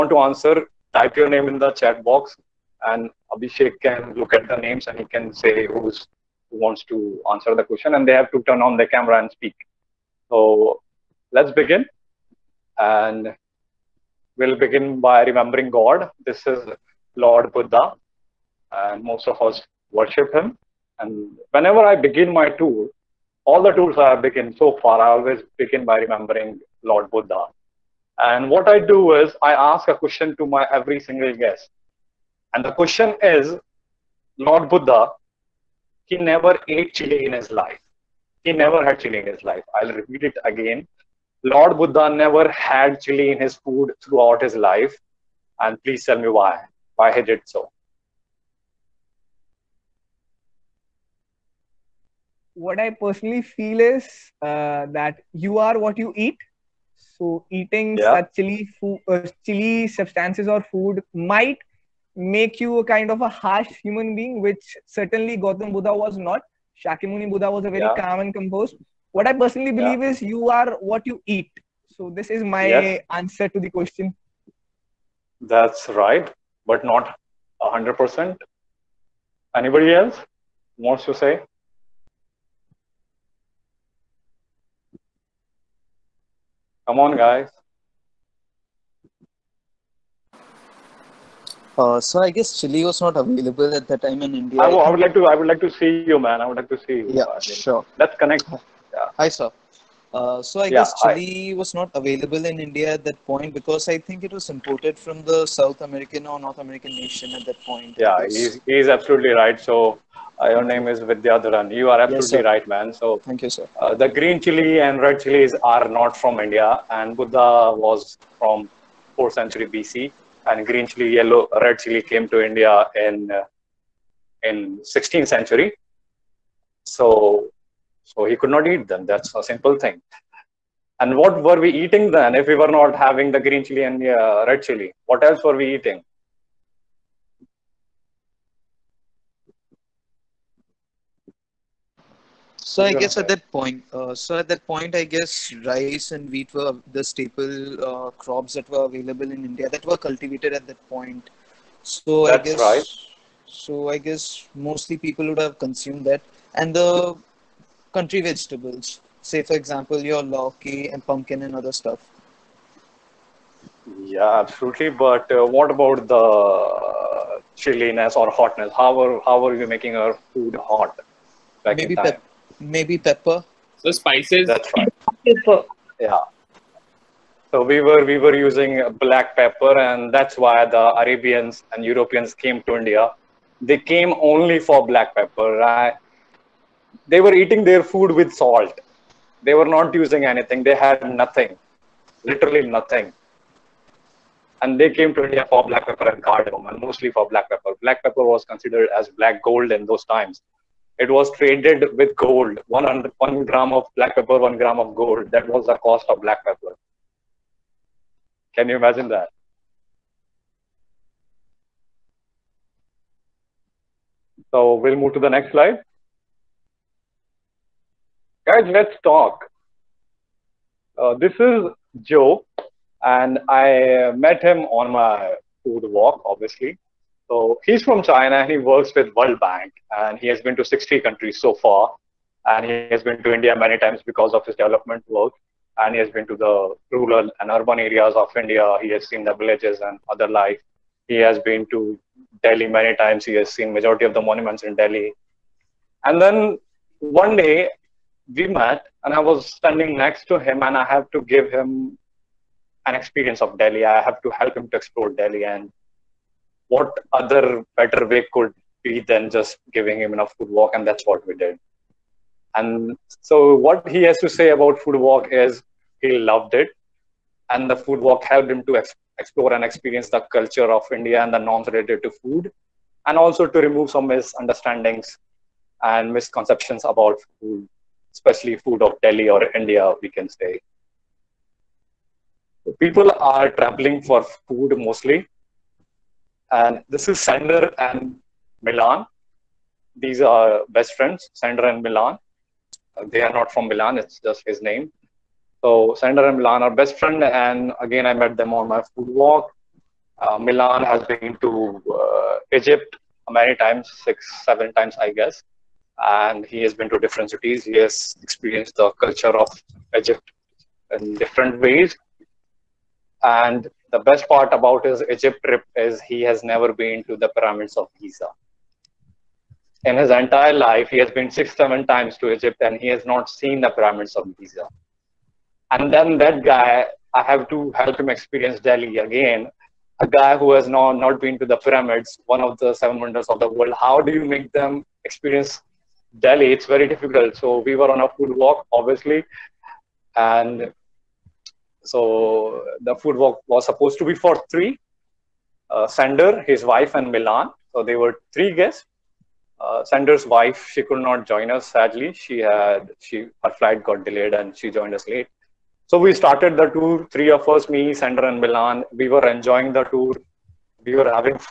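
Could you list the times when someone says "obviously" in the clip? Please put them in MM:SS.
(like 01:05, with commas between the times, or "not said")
03:46, 05:38.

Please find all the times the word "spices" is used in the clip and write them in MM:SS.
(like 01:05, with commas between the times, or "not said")
02:53.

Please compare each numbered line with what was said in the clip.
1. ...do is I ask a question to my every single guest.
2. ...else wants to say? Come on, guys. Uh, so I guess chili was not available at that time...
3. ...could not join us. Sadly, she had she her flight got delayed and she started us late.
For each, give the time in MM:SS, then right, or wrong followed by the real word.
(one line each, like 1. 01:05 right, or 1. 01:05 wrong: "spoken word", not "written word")
1. 00:28 right
2. 01:19 right
3. 05:50 wrong: "joined", not "started".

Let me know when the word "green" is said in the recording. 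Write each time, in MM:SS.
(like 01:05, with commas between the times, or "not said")
01:54, 02:00, 02:13.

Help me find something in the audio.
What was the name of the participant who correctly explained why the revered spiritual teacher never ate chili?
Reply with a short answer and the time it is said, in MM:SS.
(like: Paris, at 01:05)
Vidyadharan, at 01:50.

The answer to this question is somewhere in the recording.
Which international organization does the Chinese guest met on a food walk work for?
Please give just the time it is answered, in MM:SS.
03:49.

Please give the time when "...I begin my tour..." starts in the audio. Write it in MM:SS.
00:21.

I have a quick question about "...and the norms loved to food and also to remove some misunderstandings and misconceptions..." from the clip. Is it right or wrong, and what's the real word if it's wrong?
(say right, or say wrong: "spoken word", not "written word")
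wrong: "related", not "loved".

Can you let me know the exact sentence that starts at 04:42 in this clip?
People are traveling for food mostly.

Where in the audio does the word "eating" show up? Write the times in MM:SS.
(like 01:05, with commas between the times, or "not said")
00:57, 02:11, 02:15, 03:07.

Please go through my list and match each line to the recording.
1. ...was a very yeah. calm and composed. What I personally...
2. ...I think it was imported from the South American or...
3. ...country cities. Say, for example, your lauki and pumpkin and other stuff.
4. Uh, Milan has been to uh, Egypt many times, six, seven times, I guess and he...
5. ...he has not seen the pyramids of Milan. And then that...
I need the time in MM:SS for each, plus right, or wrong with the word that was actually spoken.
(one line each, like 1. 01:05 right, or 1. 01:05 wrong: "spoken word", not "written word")
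1. 01:07 right
2. 01:43 right
3. 02:37 wrong: "vegetables", not "cities"
4. 05:00 right
5. 05:22 wrong: "Giza", not "Milan".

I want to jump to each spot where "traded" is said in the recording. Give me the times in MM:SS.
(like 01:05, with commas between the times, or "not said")
03:21.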